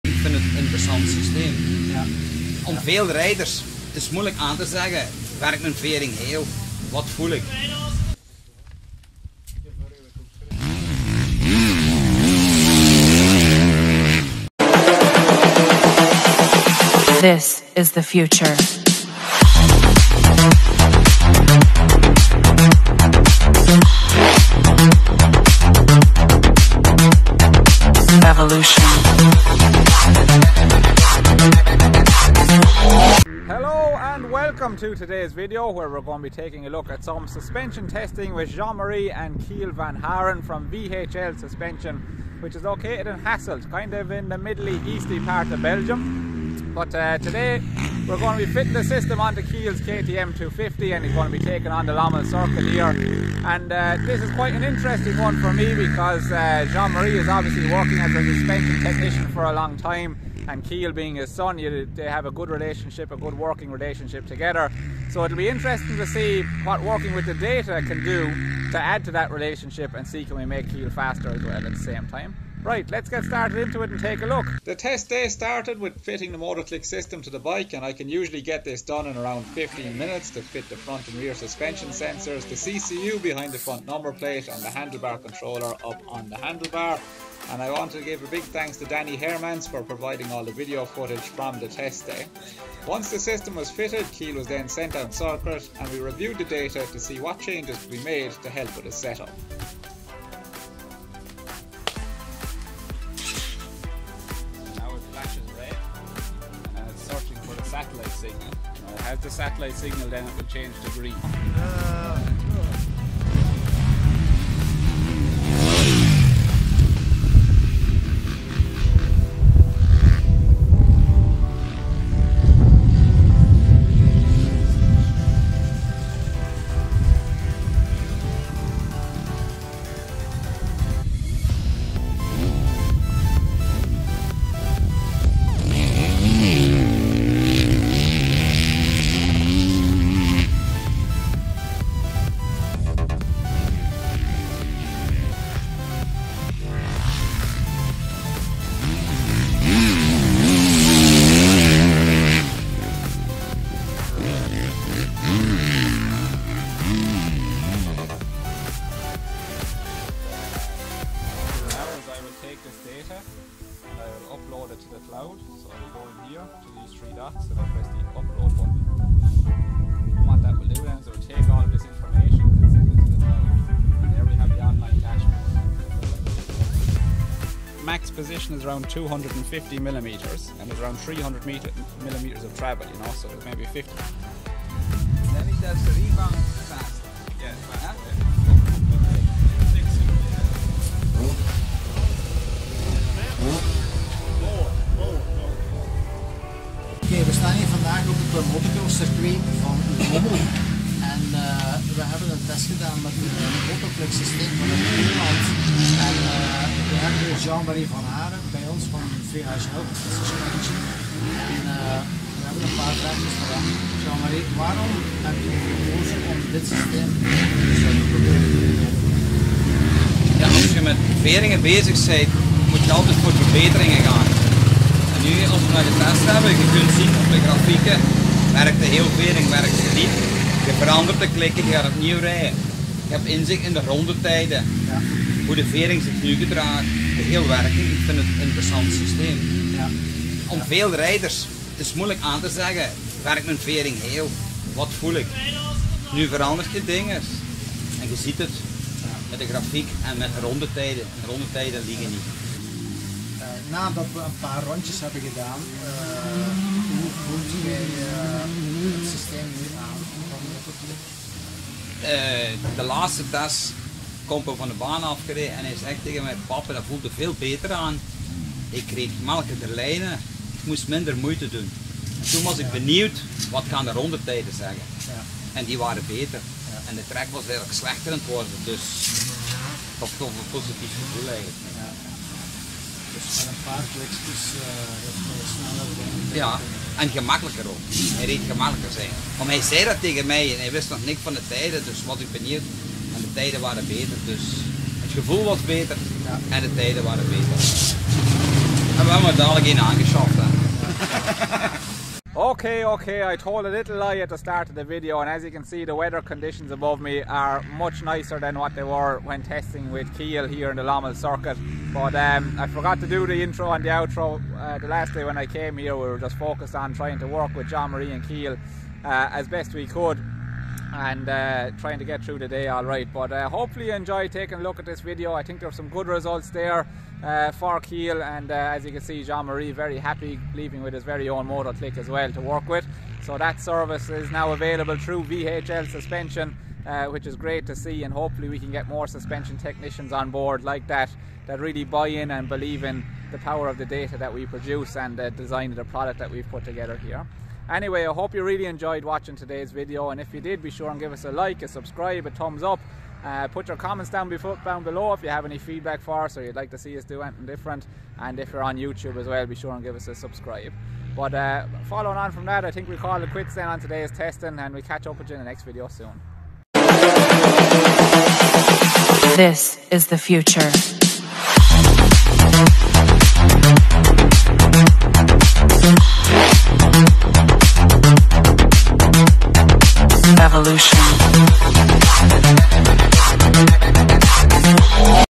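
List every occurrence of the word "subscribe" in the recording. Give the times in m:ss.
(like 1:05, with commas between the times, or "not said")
5:51, 6:00.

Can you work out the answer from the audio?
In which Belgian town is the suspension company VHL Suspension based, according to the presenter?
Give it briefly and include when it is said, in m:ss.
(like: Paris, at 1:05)
Hasselt, at 0:43.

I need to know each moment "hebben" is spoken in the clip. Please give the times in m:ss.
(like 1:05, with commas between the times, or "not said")
3:22, 3:32, 3:46, 4:15, 4:59.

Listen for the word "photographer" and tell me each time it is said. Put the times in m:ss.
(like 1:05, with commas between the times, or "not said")
not said.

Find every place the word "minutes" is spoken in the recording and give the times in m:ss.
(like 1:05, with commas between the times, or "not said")
1:19.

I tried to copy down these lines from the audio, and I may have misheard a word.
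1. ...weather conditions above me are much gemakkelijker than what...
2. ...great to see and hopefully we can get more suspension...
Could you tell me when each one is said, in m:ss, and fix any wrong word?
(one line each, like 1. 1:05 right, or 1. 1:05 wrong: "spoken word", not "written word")
1. 5:05 wrong: "nicer", not "gemakkelijker"
2. 5:37 right.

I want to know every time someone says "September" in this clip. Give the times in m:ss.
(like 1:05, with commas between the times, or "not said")
not said.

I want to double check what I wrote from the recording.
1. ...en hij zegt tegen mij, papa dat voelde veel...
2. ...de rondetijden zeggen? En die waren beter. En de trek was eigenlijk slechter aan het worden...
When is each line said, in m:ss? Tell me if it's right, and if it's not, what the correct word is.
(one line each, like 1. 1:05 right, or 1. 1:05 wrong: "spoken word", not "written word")
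1. 4:25 right
2. 4:33 right.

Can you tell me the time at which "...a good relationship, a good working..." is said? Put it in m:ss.
1:02.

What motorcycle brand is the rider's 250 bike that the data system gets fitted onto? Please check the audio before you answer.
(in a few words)
KTM.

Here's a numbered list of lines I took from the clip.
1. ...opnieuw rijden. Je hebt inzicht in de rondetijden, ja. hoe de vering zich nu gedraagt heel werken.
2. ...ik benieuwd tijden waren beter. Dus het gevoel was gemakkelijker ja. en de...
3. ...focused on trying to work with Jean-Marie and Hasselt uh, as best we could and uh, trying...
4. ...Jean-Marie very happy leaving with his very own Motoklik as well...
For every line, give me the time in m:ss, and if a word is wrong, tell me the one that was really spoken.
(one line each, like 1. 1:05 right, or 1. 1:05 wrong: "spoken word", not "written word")
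1. 3:51 right
2. 4:52 wrong: "beter", not "gemakkelijker"
3. 5:16 wrong: "Chiel", not "Hasselt"
4. 5:29 right.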